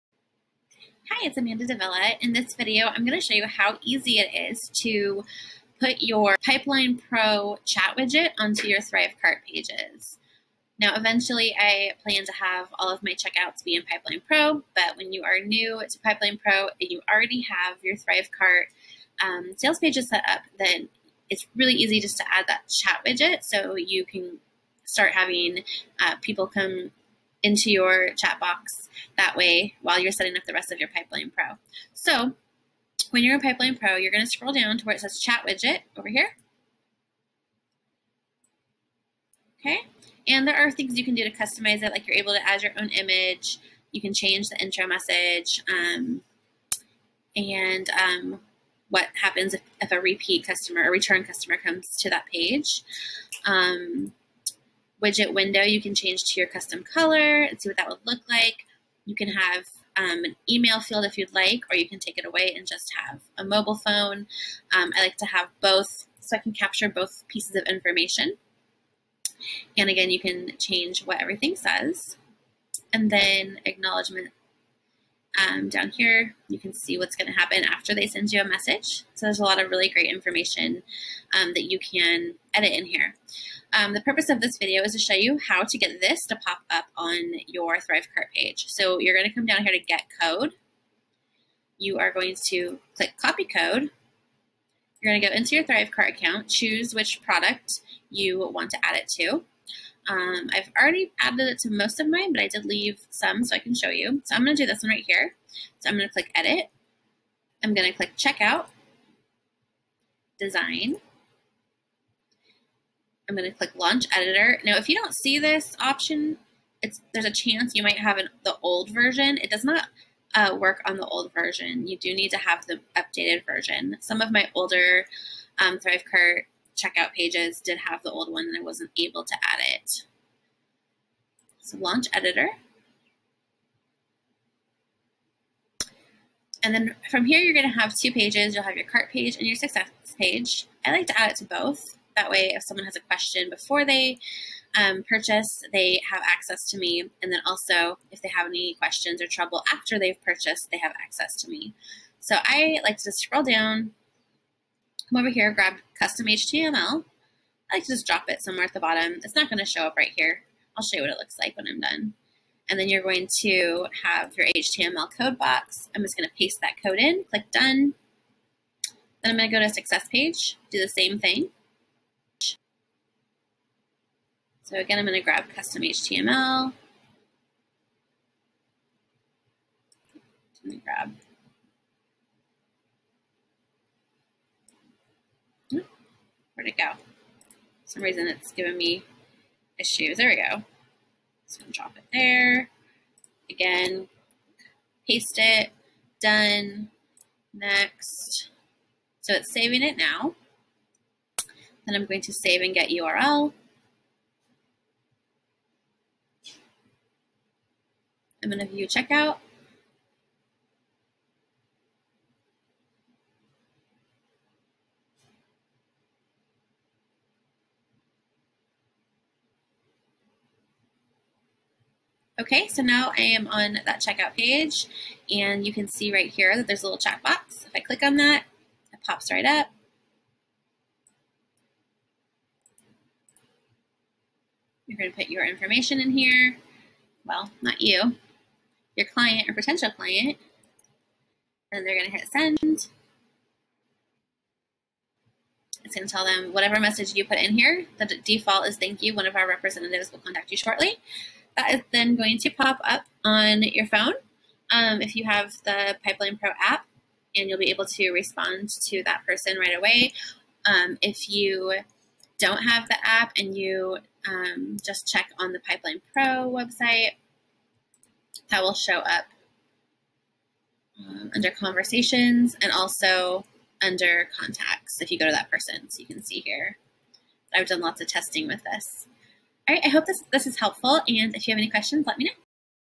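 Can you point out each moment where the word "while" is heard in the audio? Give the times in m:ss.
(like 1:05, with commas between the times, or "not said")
0:29.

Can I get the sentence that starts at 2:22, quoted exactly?
That way, if someone has a question before they um, purchase, they have access to me.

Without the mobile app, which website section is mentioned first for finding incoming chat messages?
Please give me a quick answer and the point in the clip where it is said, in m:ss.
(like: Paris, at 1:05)
conversations, at 4:31.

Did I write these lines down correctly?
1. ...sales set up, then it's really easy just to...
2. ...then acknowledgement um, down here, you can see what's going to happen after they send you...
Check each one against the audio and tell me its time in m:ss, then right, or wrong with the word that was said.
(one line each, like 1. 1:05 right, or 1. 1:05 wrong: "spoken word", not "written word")
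1. 0:19 wrong: "pages", not "sales"
2. 1:13 right.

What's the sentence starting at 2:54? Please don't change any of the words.
So again, I'm going to grab custom HTML.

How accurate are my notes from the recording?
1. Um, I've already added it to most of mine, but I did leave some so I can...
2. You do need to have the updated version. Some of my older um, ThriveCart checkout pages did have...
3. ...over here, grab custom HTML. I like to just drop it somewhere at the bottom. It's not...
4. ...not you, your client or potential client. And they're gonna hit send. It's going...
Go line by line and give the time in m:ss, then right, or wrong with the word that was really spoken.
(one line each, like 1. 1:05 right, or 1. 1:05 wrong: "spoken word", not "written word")
1. 1:40 right
2. 2:01 right
3. 2:35 right
4. 3:57 right.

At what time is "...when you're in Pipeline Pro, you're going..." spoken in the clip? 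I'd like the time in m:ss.
0:33.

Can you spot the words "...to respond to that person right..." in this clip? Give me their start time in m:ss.
4:17.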